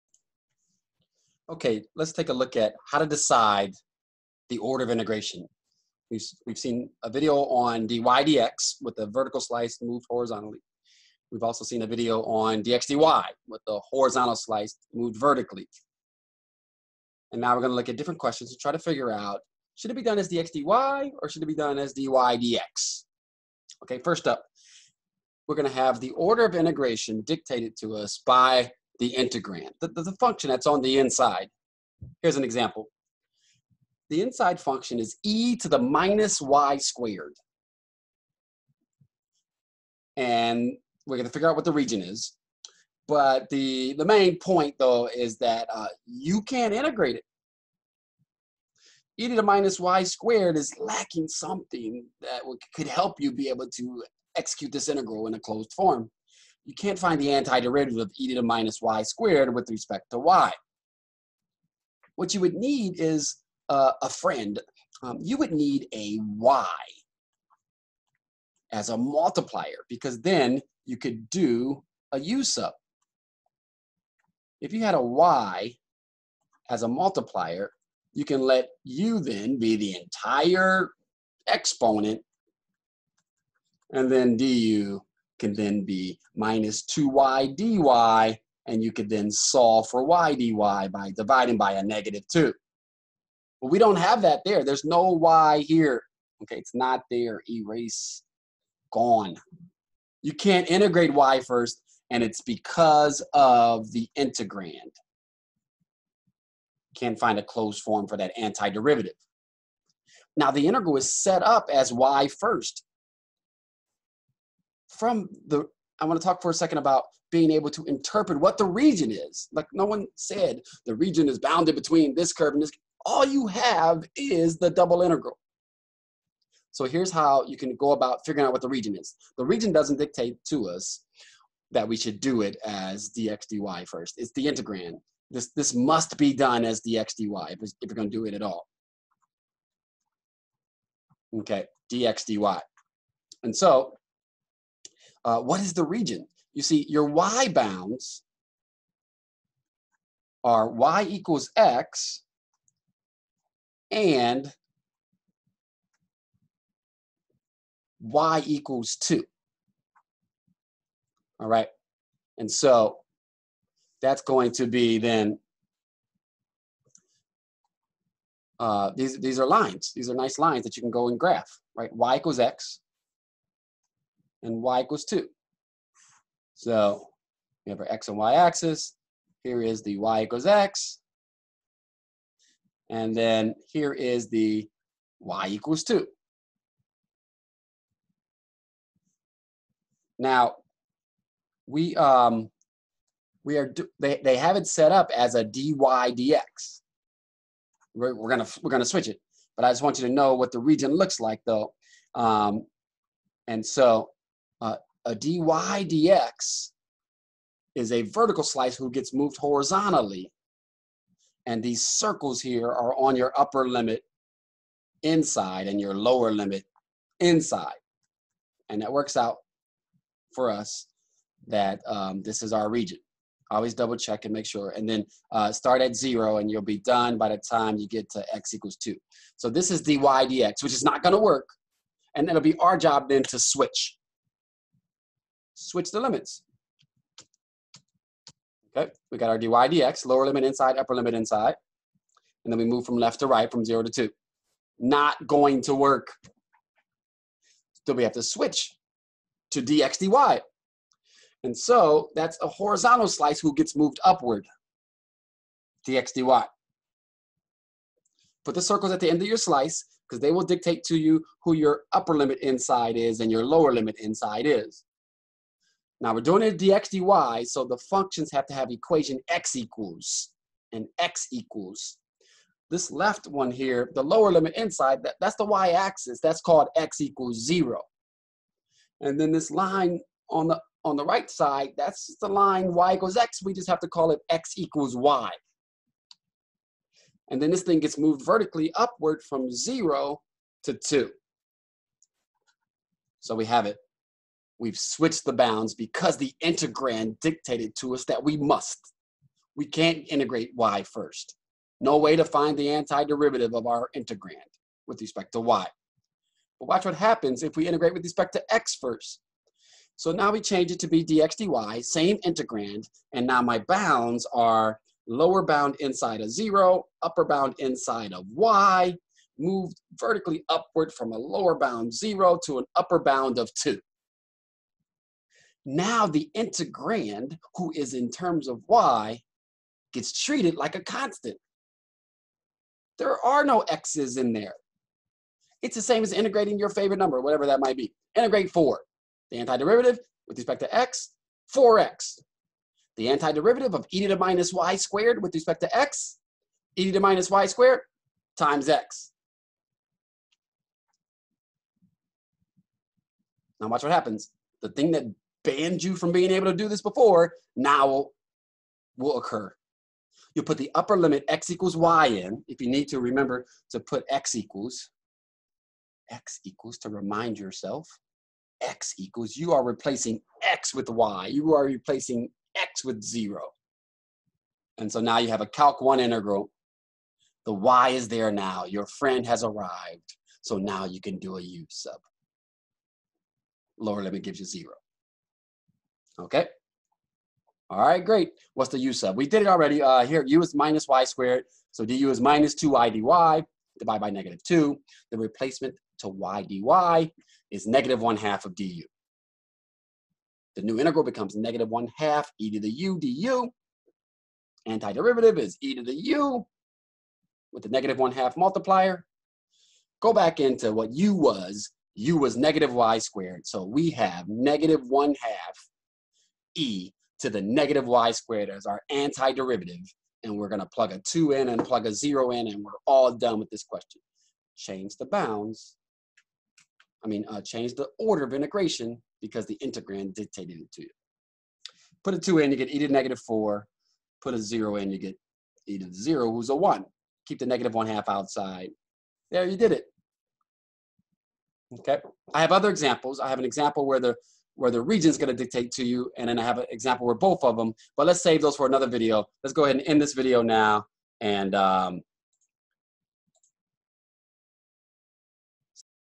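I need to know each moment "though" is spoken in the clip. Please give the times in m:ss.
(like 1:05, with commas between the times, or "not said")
0:44, 3:21.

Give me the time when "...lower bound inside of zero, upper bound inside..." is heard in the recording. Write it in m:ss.
5:15.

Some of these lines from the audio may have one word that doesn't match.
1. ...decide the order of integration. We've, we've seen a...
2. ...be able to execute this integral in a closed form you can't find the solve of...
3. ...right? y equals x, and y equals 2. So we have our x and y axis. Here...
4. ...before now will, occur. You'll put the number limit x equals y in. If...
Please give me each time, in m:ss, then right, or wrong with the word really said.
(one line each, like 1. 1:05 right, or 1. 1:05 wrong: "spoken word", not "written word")
1. 0:03 right
2. 0:53 wrong: "antiderivative", not "solve"
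3. 2:51 right
4. 5:56 wrong: "upper", not "number".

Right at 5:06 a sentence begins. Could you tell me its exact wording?
But watch what happens if we integrate with respect to x first.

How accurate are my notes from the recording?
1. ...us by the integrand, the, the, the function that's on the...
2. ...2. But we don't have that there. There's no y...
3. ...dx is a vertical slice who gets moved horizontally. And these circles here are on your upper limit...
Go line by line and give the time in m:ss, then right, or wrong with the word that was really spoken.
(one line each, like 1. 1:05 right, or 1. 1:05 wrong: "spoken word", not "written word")
1. 0:27 right
2. 1:32 right
3. 3:25 right.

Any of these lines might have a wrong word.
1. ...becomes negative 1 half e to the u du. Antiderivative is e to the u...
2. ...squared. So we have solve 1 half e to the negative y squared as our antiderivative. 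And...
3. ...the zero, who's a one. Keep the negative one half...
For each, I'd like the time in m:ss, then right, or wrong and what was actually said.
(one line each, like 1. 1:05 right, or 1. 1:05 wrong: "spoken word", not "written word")
1. 6:41 right
2. 6:52 wrong: "negative", not "solve"
3. 7:15 right.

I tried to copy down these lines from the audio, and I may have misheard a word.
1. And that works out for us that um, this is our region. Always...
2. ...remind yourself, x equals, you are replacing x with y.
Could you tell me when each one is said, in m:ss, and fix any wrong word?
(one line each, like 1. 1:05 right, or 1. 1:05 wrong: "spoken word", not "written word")
1. 3:38 right
2. 6:06 right.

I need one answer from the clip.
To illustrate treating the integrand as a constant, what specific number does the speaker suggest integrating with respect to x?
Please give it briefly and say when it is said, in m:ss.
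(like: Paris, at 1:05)
4, at 5:38.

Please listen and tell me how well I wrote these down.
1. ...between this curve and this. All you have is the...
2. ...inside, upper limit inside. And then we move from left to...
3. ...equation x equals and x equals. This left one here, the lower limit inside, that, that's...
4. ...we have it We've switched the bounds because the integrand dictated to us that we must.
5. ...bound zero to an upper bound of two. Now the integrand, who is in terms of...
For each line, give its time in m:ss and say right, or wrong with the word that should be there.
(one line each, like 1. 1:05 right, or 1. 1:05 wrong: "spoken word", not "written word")
1. 2:01 right
2. 4:00 right
3. 4:28 right
4. 4:53 right
5. 5:21 right.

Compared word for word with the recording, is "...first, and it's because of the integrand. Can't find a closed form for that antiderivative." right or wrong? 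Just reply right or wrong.
right.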